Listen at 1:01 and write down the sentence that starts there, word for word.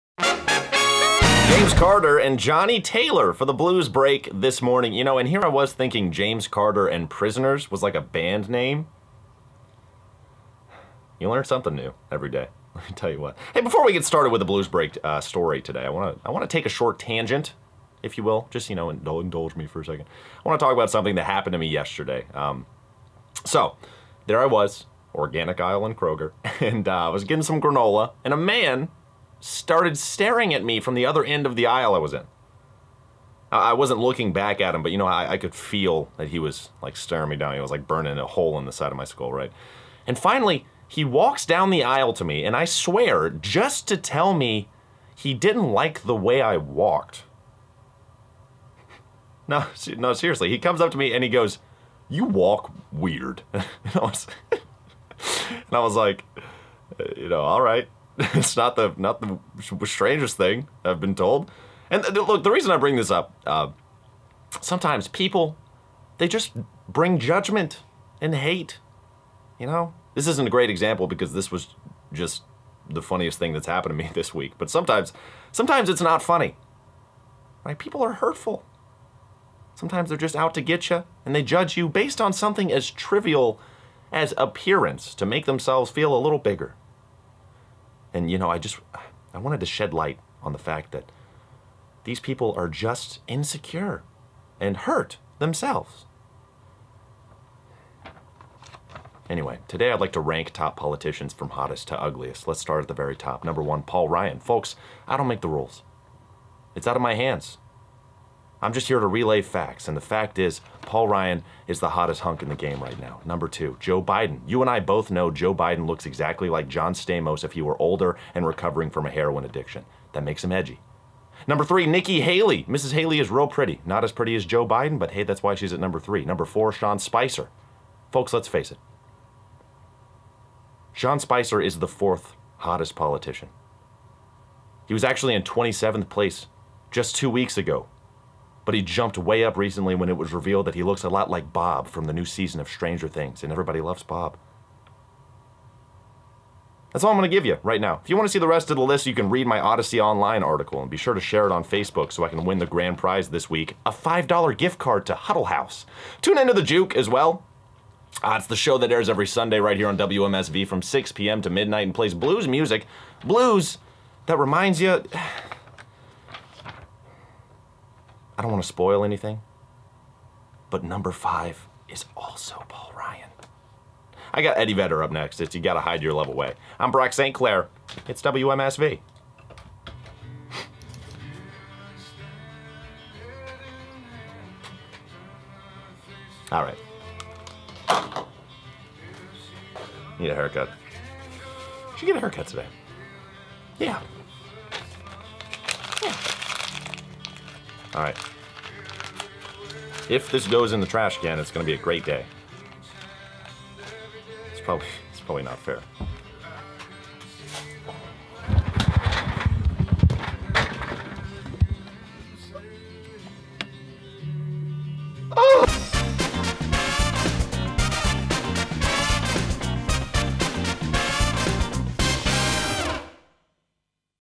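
And look, the reason I bring this up, uh, sometimes people, they just bring judgment and hate.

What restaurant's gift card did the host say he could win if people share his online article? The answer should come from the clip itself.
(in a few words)
Huddle House.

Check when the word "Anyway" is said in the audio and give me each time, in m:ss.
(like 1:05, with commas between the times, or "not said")
1:39.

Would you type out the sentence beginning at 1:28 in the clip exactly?
And you know, I just I wanted to shed light on the fact that these people are just insecure and hurt themselves.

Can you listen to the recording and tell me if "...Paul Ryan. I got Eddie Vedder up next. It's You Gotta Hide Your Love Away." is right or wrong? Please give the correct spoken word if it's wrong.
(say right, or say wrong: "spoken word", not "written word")
right.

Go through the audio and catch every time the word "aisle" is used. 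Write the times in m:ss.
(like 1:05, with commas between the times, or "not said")
0:31, 0:41.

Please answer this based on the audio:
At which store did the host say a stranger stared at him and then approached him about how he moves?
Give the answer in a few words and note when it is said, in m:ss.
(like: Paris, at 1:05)
Organic Island Kroger, at 0:25.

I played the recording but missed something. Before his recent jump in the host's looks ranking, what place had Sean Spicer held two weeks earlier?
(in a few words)
27th.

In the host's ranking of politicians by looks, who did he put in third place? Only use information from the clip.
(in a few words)
Nikki Haley.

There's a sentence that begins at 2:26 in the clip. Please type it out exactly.
That's all I'm going to give you right now.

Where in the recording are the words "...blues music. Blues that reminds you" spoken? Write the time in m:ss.
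2:42.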